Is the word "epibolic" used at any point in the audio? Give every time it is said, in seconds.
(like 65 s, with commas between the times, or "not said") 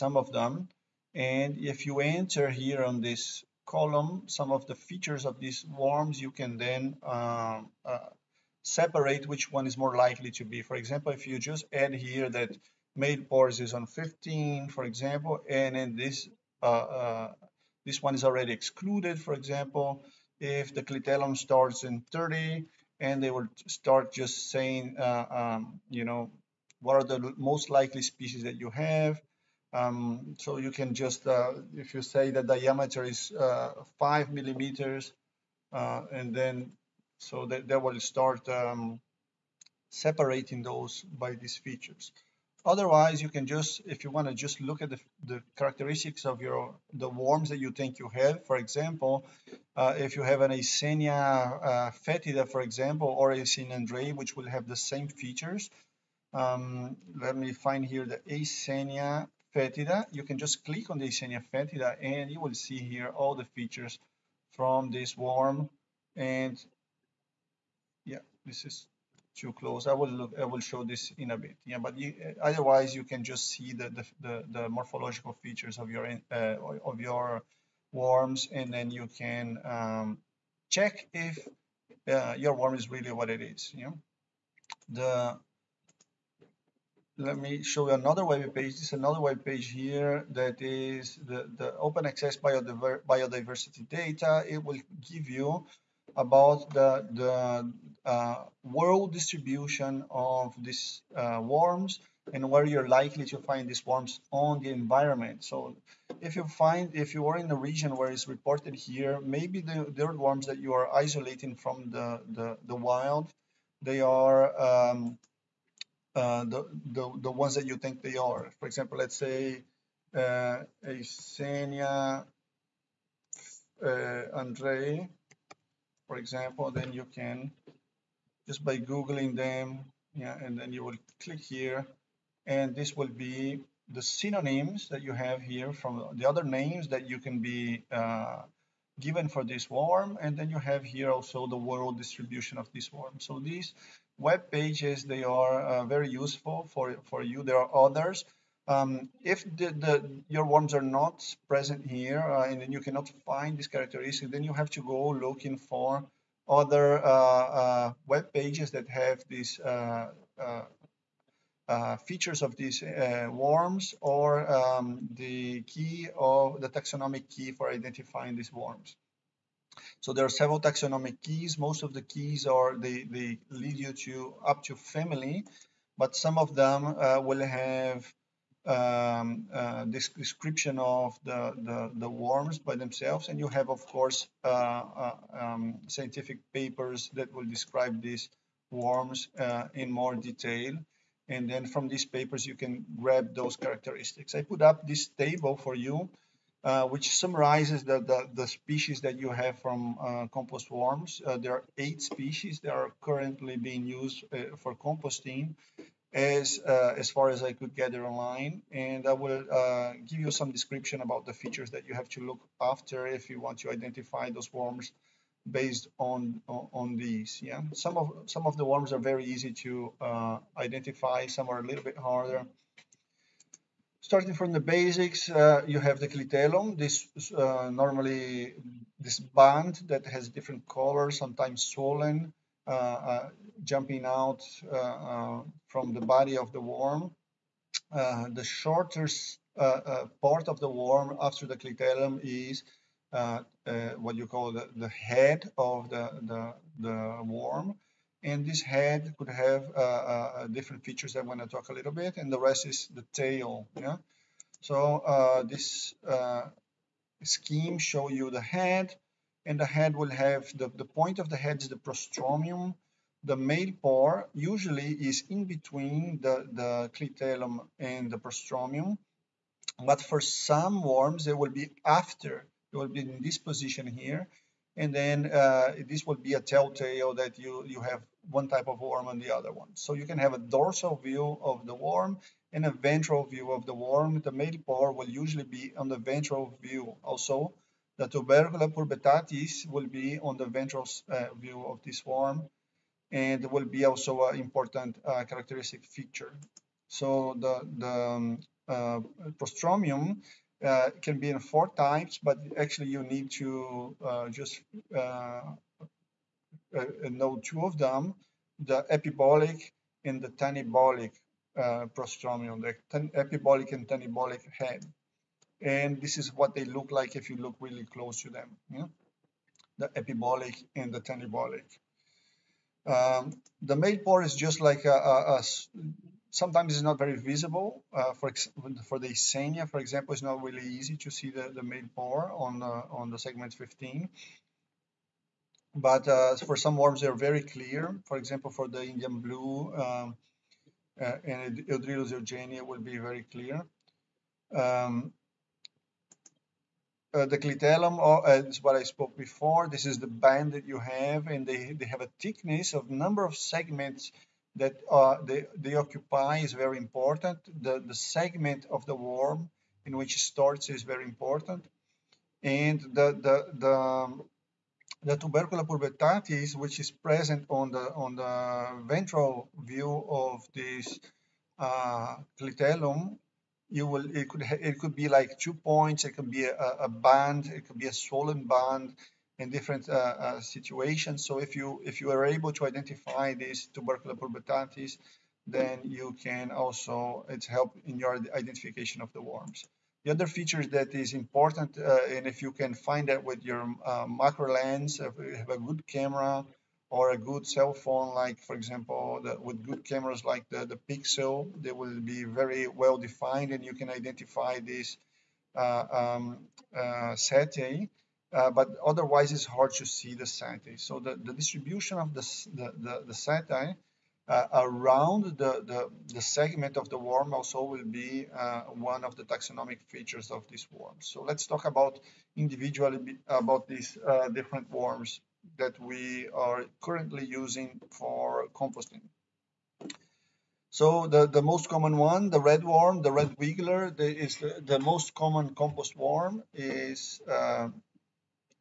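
308 s, 313 s, 319 s.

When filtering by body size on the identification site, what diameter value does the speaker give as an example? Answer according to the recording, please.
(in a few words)
5 millimeters.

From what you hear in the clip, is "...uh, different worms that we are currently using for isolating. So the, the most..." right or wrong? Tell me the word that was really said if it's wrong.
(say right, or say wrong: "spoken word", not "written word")
wrong: "composting", not "isolating".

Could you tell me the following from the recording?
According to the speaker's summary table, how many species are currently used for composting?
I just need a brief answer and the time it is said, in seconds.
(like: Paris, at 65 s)
8, at 201 s.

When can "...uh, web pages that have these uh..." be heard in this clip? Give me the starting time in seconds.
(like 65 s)
157 s.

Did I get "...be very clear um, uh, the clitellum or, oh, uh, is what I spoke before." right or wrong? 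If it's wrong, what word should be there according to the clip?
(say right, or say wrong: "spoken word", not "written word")
right.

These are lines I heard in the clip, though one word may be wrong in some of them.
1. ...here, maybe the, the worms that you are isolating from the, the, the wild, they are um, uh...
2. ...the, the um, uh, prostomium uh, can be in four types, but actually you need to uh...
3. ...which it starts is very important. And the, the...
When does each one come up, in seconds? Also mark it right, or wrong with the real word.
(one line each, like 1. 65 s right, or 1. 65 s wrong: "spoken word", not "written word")
1. 108 s right
2. 297 s right
3. 359 s right.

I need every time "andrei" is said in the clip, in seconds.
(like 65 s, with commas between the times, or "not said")
53 s, 124 s.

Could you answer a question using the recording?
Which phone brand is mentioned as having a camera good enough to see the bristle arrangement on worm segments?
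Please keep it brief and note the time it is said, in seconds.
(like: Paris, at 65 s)
Pixel, at 400 s.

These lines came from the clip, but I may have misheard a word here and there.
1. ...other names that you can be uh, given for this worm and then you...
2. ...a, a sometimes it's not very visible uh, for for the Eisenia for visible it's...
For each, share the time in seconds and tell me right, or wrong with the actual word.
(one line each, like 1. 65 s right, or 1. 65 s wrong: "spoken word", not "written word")
1. 136 s right
2. 324 s wrong: "example", not "visible".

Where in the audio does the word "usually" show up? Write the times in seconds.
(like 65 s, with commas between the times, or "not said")
264 s, 285 s.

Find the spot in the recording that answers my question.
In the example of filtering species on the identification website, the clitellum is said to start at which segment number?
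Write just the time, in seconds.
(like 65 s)
22 s.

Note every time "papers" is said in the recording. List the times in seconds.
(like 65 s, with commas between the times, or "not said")
186 s, 192 s.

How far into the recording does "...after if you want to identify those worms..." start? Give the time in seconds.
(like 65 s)
212 s.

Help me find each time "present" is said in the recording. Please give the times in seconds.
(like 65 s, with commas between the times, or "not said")
151 s, 366 s.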